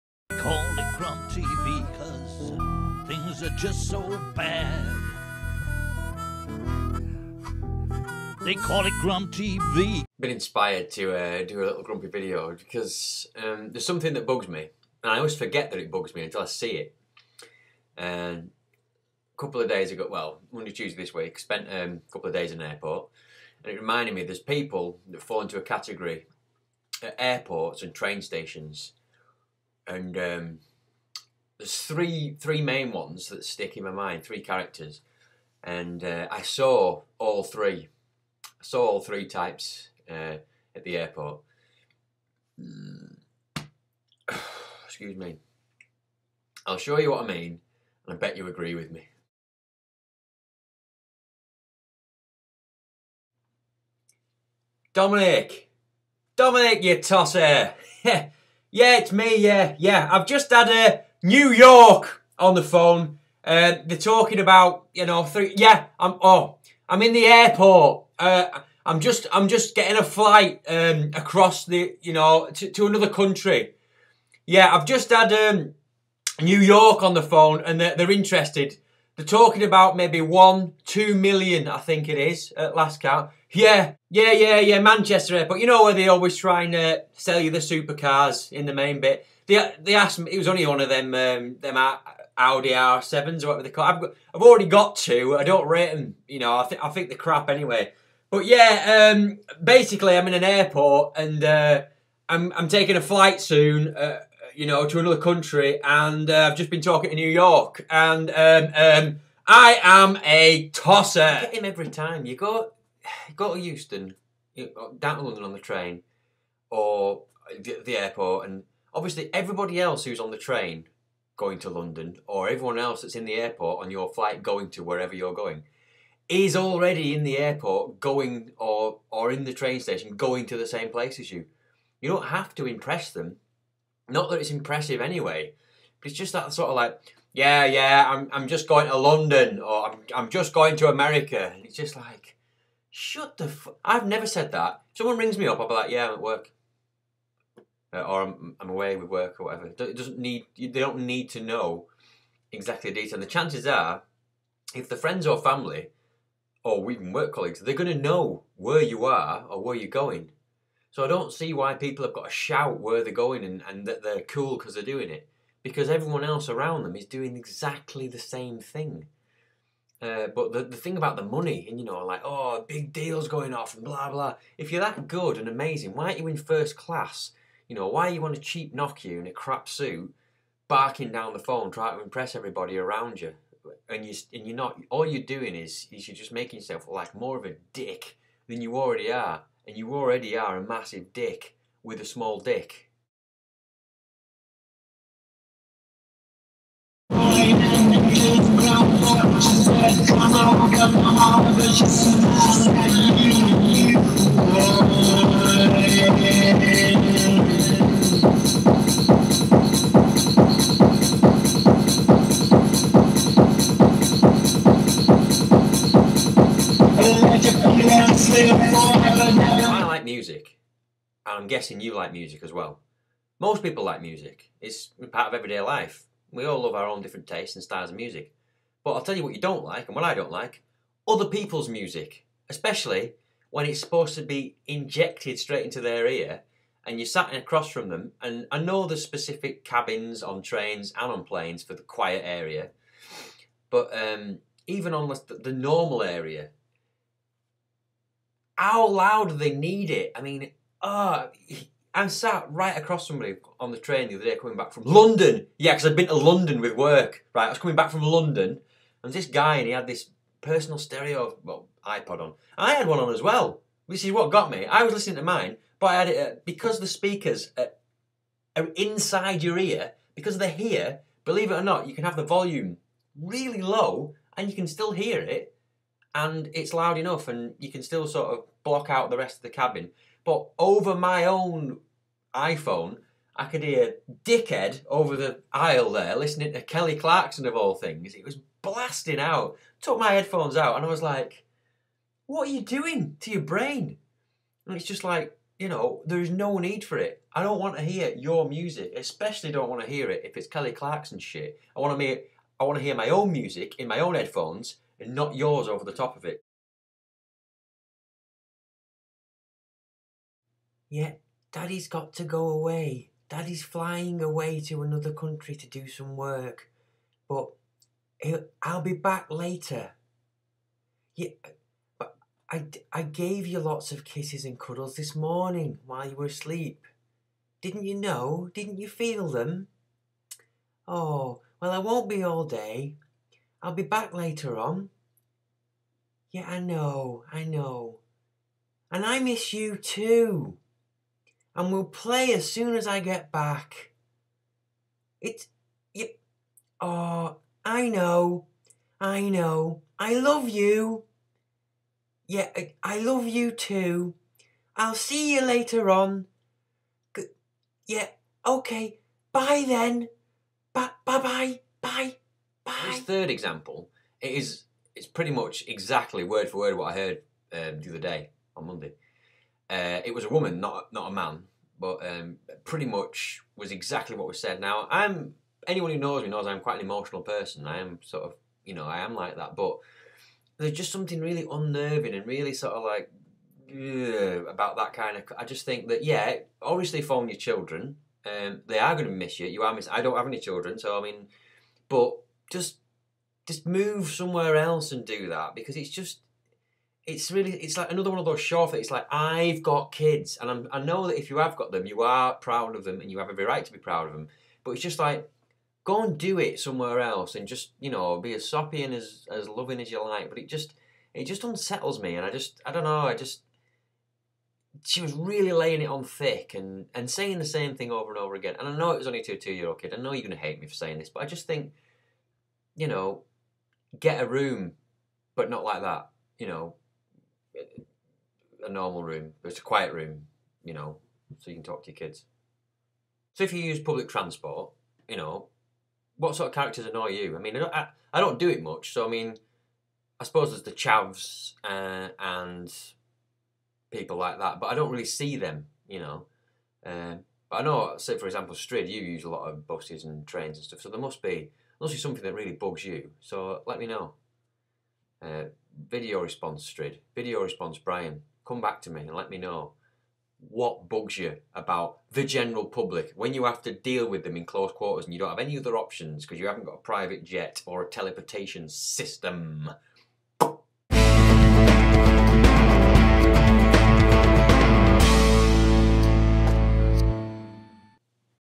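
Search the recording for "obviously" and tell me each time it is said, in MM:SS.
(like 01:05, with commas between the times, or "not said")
01:58, 06:26.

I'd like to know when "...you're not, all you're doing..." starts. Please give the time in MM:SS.
03:04.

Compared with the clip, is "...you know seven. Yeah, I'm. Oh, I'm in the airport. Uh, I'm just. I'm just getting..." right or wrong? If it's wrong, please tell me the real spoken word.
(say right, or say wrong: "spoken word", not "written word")
wrong: "three", not "seven".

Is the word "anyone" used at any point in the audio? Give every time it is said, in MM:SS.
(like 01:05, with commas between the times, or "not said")
06:15.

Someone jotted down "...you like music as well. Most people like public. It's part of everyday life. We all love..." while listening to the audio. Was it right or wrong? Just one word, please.
wrong.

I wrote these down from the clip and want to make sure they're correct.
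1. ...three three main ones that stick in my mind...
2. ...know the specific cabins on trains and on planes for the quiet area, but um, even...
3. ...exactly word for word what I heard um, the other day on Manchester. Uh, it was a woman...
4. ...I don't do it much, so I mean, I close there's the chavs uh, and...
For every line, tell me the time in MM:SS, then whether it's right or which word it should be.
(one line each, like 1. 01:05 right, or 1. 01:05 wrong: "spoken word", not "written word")
1. 00:31 right
2. 03:58 right
3. 06:05 wrong: "Monday", not "Manchester"
4. 07:18 wrong: "suppose", not "close".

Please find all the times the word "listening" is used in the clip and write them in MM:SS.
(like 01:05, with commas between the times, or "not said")
04:24, 04:46.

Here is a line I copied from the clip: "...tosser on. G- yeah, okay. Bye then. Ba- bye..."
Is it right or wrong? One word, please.
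wrong.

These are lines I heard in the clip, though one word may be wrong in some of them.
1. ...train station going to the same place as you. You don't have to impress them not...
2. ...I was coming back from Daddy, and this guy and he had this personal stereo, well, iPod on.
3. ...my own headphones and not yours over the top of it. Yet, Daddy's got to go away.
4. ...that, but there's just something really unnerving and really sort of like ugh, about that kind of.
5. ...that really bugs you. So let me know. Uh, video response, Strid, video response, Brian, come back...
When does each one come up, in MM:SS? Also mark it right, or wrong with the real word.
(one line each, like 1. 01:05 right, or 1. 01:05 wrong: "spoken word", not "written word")
1. 02:09 right
2. 04:17 wrong: "London", not "Daddy"
3. 05:03 right
4. 06:19 right
5. 07:32 right.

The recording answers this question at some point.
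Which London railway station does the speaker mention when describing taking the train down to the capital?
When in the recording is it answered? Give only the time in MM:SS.
01:53.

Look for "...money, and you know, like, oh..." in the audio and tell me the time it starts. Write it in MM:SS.
02:51.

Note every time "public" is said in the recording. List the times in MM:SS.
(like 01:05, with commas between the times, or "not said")
07:13, 07:42.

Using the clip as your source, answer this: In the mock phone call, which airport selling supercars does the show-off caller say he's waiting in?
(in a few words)
Manchester Airport.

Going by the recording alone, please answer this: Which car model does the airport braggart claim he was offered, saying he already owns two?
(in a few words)
Audi R7.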